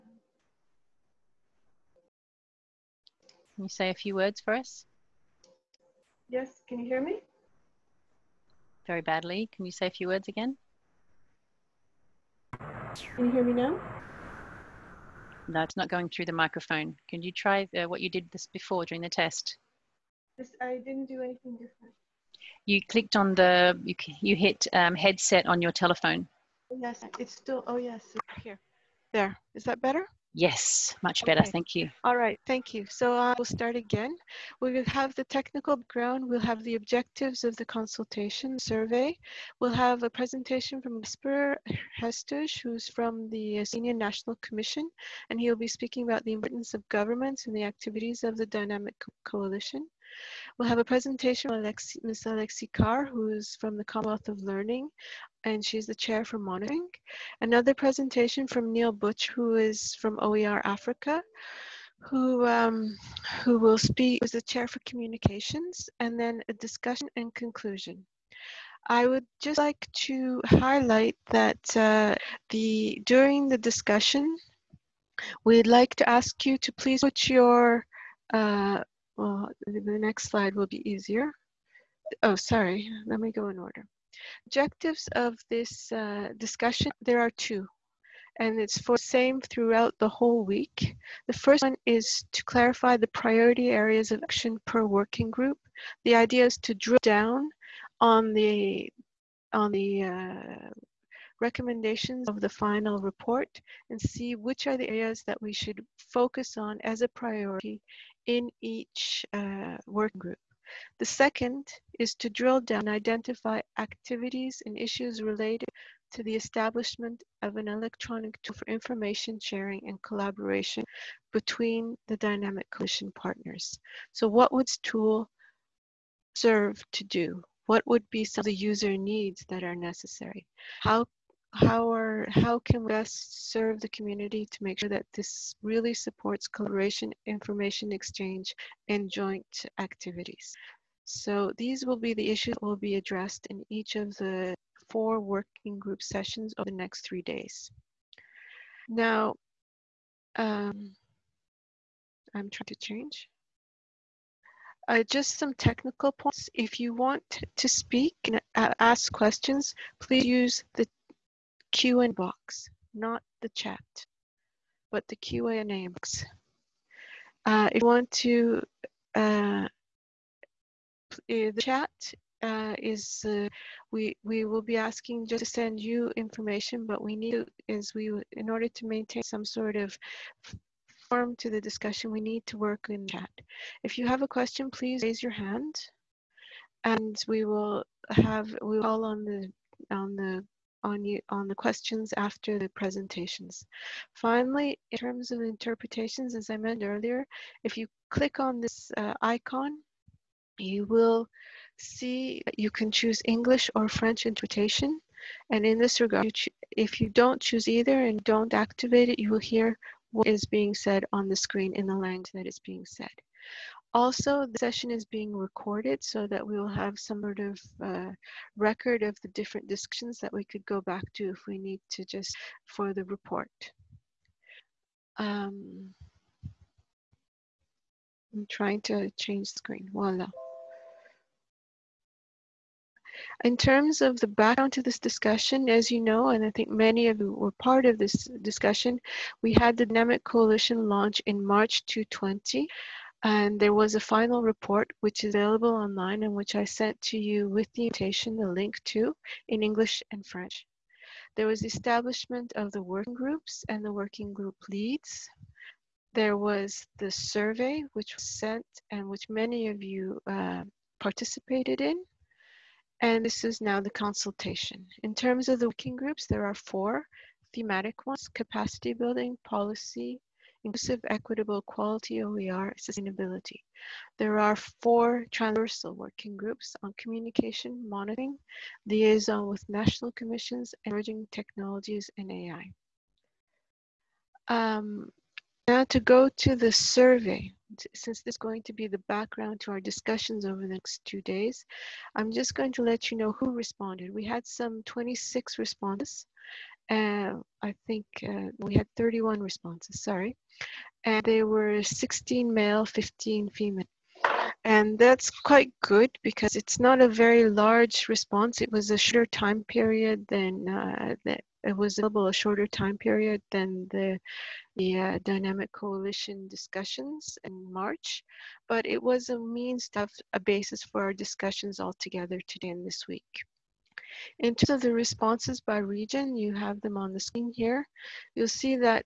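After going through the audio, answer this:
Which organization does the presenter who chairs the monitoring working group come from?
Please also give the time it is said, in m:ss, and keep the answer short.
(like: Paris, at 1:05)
Commonwealth of Learning, at 0:53.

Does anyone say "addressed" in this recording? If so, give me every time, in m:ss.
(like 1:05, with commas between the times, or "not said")
2:22.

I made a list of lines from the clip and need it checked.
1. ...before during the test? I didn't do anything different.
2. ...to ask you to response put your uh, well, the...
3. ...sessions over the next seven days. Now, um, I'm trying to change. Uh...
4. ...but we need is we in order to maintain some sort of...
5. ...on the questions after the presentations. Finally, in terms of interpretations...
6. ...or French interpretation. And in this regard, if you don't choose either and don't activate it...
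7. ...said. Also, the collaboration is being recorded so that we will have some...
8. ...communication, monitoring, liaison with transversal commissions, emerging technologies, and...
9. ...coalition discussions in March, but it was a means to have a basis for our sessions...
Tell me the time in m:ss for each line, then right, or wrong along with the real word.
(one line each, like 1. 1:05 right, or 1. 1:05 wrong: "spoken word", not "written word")
1. 0:18 right
2. 1:15 wrong: "please", not "response"
3. 2:26 wrong: "three", not "seven"
4. 2:56 right
5. 3:11 right
6. 3:23 right
7. 3:32 wrong: "session", not "collaboration"
8. 4:36 wrong: "national", not "transversal"
9. 5:15 wrong: "discussions", not "sessions".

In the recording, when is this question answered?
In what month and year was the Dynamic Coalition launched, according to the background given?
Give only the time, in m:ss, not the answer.
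4:01.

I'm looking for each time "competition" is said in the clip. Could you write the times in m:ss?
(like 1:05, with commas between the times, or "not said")
not said.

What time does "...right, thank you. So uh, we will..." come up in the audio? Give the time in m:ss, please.
0:32.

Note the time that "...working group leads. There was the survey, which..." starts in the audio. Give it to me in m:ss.
4:13.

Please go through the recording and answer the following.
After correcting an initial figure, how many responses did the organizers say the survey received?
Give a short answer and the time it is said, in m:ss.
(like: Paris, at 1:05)
31, at 4:58.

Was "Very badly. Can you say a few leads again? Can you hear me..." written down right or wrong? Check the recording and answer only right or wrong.
wrong.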